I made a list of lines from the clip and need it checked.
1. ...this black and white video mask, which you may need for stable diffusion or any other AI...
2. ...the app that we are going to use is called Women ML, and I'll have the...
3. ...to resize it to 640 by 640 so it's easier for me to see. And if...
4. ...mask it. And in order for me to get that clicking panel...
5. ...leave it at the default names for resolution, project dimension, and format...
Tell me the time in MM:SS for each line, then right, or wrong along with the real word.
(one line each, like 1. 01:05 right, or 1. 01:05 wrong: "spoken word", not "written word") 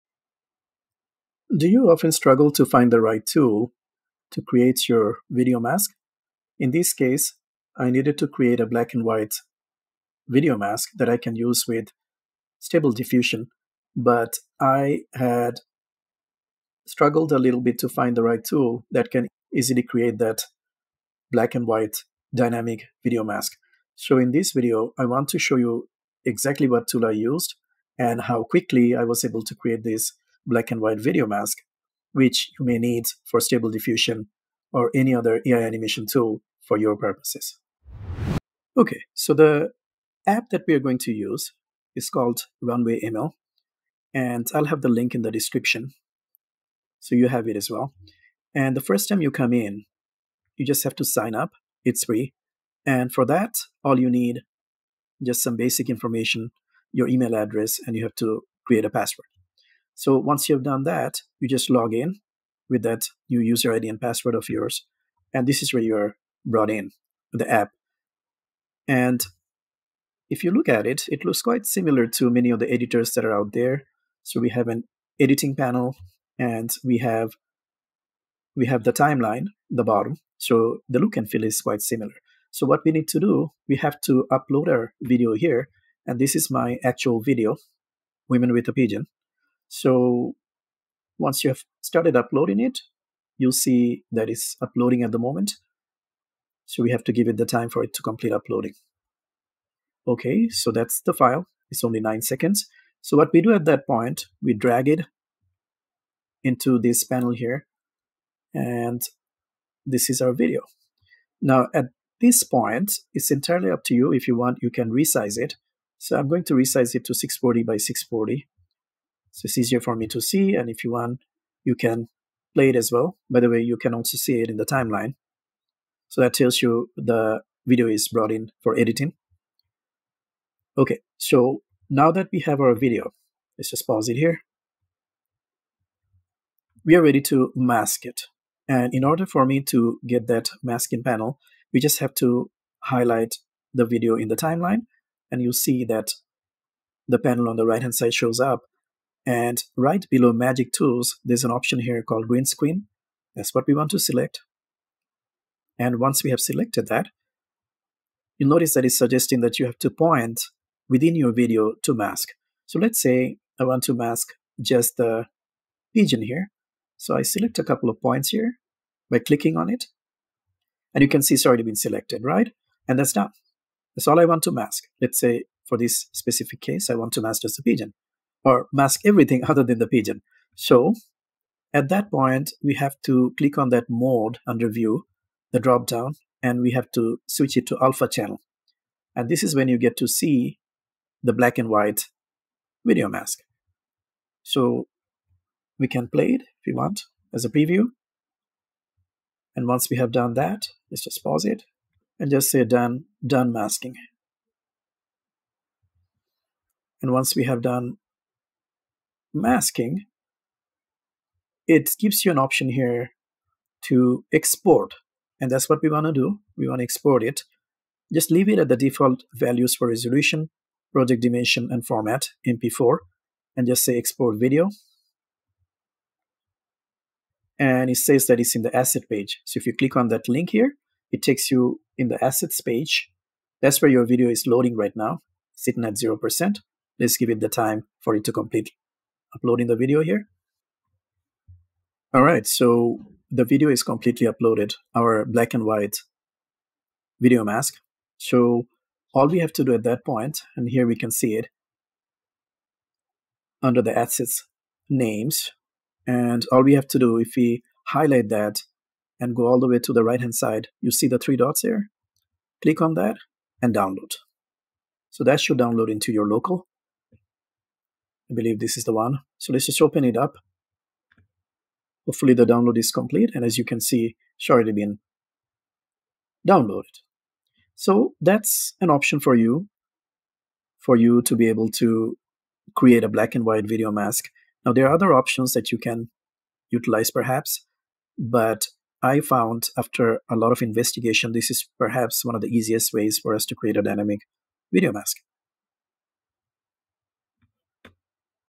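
1. 00:29 right
2. 00:39 wrong: "Runway", not "Women"
3. 01:56 right
4. 02:17 wrong: "masking", not "clicking"
5. 03:38 wrong: "values", not "names".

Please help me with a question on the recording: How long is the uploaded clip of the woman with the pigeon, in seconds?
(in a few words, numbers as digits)
9.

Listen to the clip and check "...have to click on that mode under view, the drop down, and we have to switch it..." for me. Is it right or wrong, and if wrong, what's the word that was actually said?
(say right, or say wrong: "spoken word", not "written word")
right.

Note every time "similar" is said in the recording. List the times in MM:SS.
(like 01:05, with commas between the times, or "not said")
01:11, 01:21.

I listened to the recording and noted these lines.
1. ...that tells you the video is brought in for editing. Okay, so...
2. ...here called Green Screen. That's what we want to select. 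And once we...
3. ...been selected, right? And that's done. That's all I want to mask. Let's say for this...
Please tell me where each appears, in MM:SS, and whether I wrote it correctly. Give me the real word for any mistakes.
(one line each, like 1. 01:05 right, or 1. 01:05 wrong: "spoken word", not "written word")
1. 02:06 right
2. 02:31 right
3. 02:51 right.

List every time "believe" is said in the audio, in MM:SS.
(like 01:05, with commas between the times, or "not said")
04:28.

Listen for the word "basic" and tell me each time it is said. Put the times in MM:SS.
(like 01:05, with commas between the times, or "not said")
00:55.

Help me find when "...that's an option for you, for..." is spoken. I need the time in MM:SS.
04:38.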